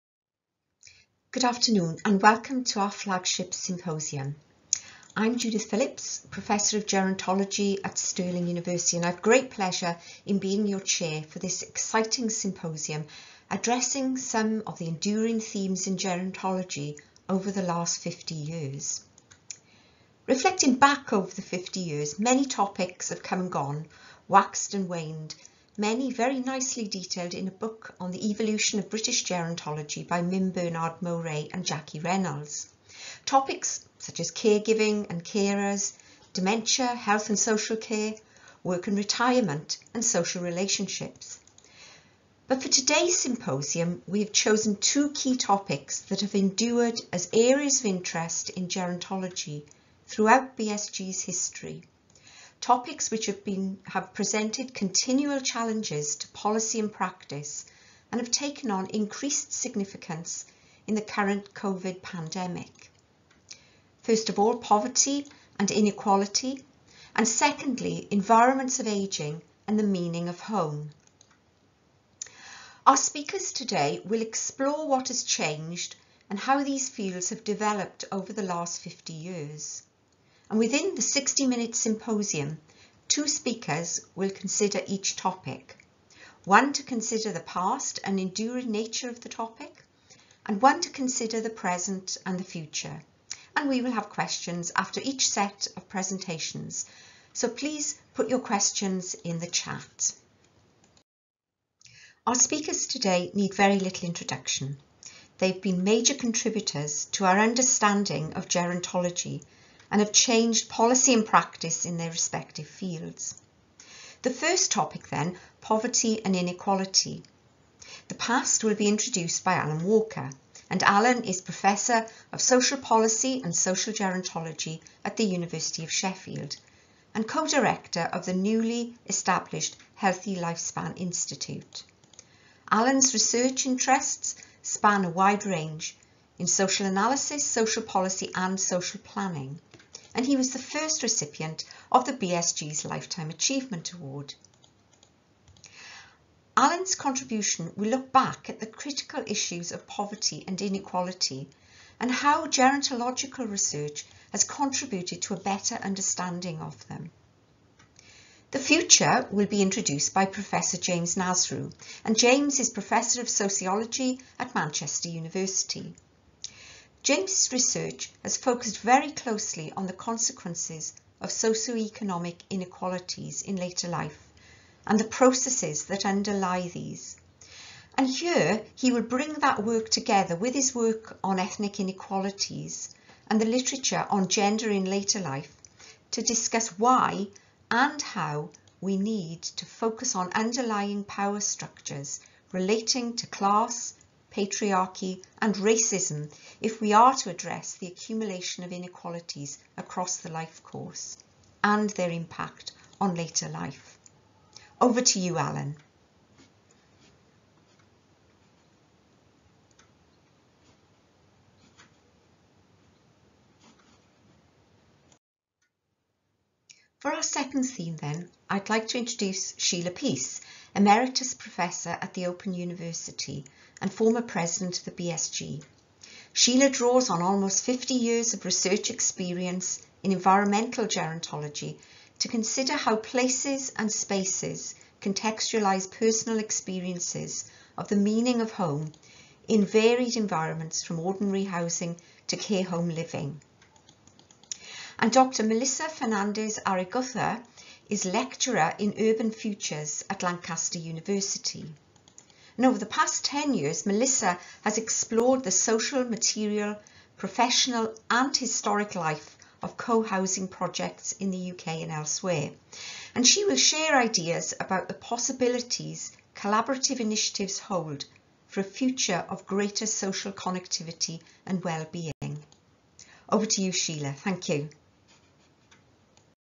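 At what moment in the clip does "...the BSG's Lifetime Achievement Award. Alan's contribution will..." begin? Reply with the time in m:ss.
2:22.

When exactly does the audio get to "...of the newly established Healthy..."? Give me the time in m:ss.
2:08.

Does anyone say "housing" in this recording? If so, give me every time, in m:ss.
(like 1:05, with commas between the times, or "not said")
4:01, 4:19.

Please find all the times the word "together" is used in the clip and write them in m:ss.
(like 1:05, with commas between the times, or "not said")
2:59.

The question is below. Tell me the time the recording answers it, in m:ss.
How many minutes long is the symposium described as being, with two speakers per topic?
1:21.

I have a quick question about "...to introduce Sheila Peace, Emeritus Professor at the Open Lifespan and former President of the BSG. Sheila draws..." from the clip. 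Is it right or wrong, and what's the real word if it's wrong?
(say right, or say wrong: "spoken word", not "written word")
wrong: "University", not "Lifespan".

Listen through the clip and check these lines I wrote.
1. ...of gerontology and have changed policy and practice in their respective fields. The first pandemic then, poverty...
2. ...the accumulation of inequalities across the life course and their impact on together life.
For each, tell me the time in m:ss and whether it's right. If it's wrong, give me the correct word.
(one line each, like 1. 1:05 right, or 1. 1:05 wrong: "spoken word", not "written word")
1. 1:48 wrong: "topic", not "pandemic"
2. 3:17 wrong: "later", not "together".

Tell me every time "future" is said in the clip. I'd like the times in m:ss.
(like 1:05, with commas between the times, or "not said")
1:32, 2:38, 4:09, 4:28.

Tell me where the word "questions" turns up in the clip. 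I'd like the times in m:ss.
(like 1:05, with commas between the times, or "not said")
1:34, 1:38.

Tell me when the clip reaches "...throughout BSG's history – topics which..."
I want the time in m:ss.
0:50.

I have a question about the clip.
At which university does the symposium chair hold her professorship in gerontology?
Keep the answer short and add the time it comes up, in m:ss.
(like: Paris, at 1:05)
Stirling University, at 0:07.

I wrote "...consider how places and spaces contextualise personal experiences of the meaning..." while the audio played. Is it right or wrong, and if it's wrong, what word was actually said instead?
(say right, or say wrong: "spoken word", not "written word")
right.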